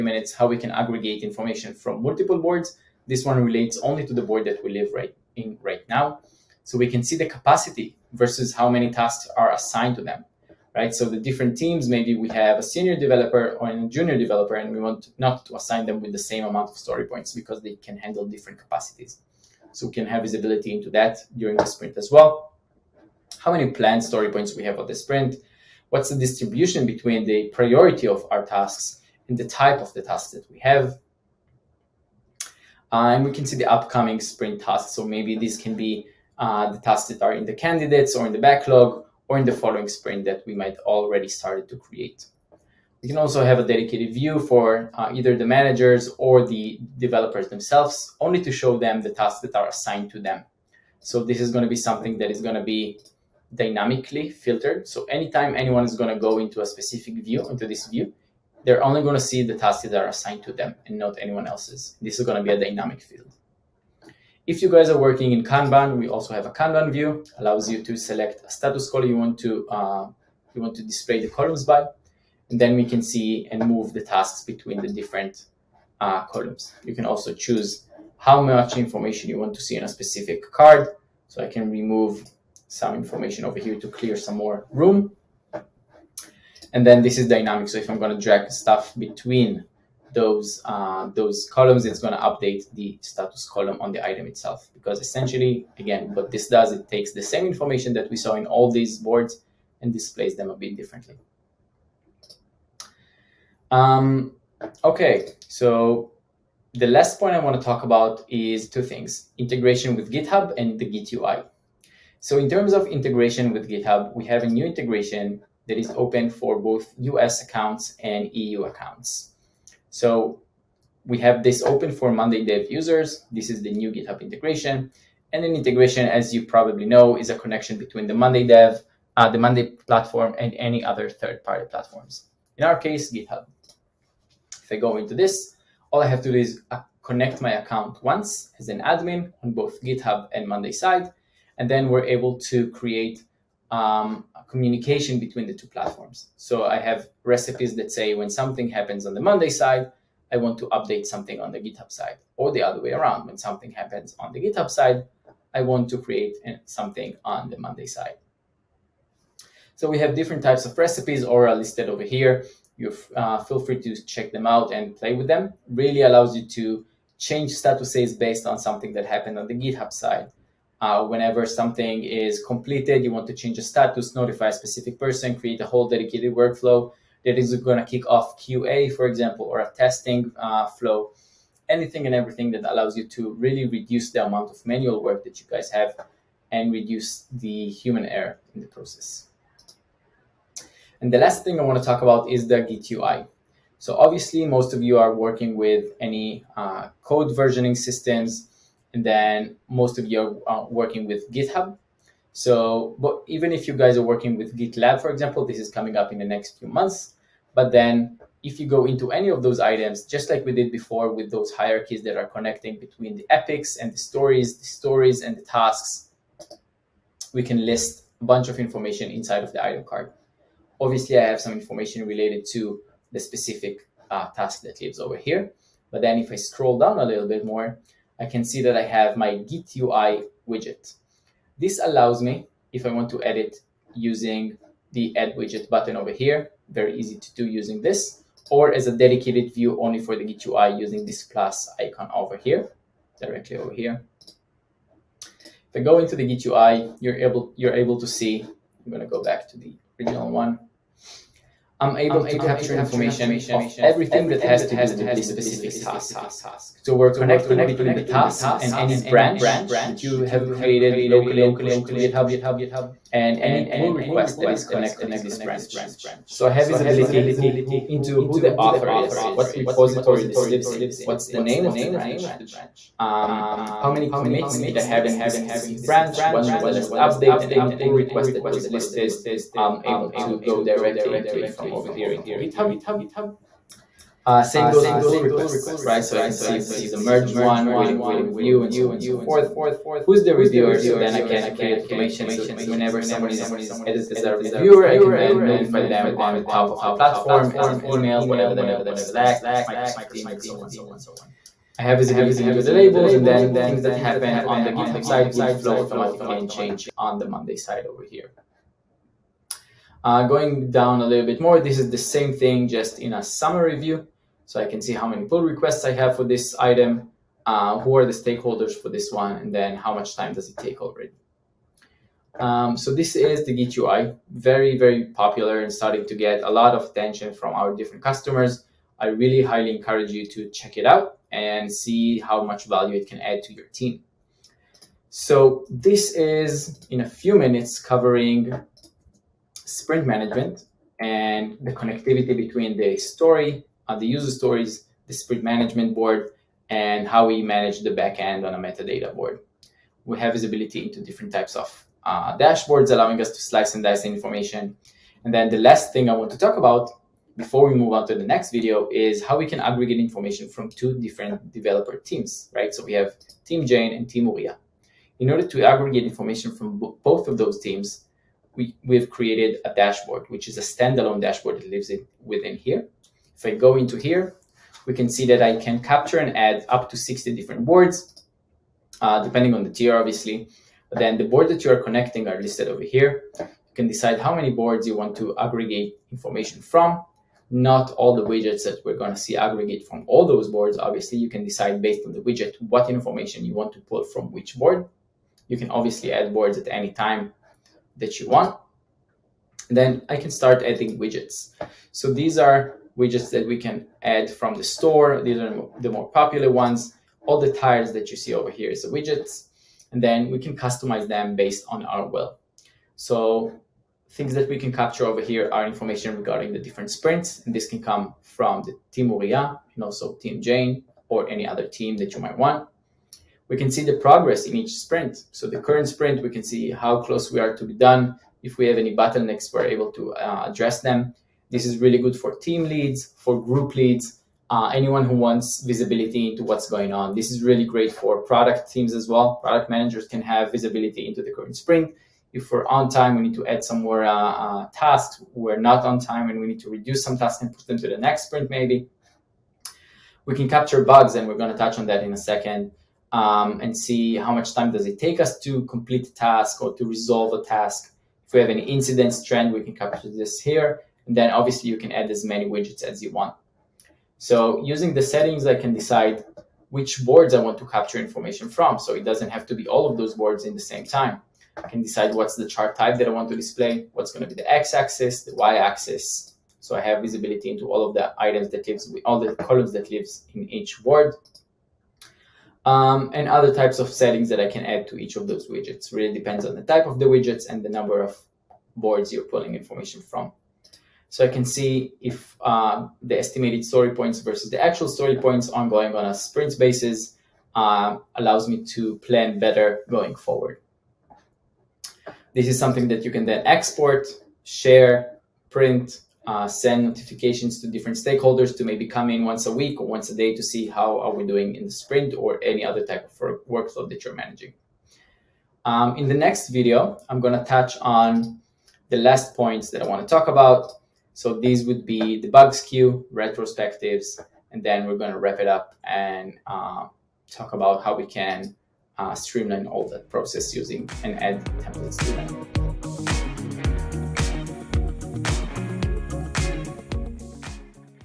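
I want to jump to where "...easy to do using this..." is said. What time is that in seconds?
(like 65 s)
236 s.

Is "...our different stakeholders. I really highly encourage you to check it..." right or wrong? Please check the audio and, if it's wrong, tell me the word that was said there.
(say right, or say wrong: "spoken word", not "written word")
wrong: "customers", not "stakeholders".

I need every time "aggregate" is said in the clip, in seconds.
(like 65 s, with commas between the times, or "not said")
0 s, 359 s, 365 s, 385 s, 389 s.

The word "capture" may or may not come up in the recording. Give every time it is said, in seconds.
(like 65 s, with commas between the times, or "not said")
252 s, 375 s, 414 s, 450 s, 459 s, 467 s.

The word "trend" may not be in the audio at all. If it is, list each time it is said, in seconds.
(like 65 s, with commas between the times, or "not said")
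459 s.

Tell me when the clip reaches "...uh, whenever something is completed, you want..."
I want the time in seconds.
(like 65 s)
170 s.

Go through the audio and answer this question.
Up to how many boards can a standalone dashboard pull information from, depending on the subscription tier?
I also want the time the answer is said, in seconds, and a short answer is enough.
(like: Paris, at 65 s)
60, at 376 s.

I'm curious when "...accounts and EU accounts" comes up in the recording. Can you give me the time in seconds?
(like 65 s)
117 s.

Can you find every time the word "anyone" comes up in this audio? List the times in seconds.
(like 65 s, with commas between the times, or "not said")
55 s, 61 s, 434 s.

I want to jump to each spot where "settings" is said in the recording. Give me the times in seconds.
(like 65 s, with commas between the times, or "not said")
465 s, 483 s.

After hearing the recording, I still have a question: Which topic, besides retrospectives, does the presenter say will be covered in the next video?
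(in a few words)
Bugs queue.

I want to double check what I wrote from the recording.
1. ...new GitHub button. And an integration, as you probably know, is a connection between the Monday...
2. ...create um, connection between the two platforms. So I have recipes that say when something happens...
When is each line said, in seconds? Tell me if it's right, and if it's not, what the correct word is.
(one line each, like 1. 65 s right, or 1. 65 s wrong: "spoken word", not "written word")
1. 123 s wrong: "integration", not "button"
2. 142 s wrong: "communication", not "connection".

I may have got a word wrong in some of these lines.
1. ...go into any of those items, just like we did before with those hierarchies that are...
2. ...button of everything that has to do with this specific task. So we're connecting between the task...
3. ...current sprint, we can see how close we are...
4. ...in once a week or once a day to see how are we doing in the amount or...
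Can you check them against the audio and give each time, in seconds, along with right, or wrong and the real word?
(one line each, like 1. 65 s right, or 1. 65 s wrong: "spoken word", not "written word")
1. 208 s right
2. 252 s wrong: "information", not "button"
3. 425 s right
4. 509 s wrong: "sprint", not "amount".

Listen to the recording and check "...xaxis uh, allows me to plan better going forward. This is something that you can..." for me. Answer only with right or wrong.
wrong.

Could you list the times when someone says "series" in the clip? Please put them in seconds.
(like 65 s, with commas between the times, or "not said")
not said.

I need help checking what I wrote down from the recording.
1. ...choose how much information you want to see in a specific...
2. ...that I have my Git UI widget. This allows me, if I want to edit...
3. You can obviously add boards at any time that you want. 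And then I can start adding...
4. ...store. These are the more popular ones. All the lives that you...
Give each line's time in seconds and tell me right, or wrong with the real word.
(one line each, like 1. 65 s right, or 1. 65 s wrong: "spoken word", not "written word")
1. 77 s right
2. 228 s right
3. 395 s right
4. 404 s wrong: "tires", not "lives".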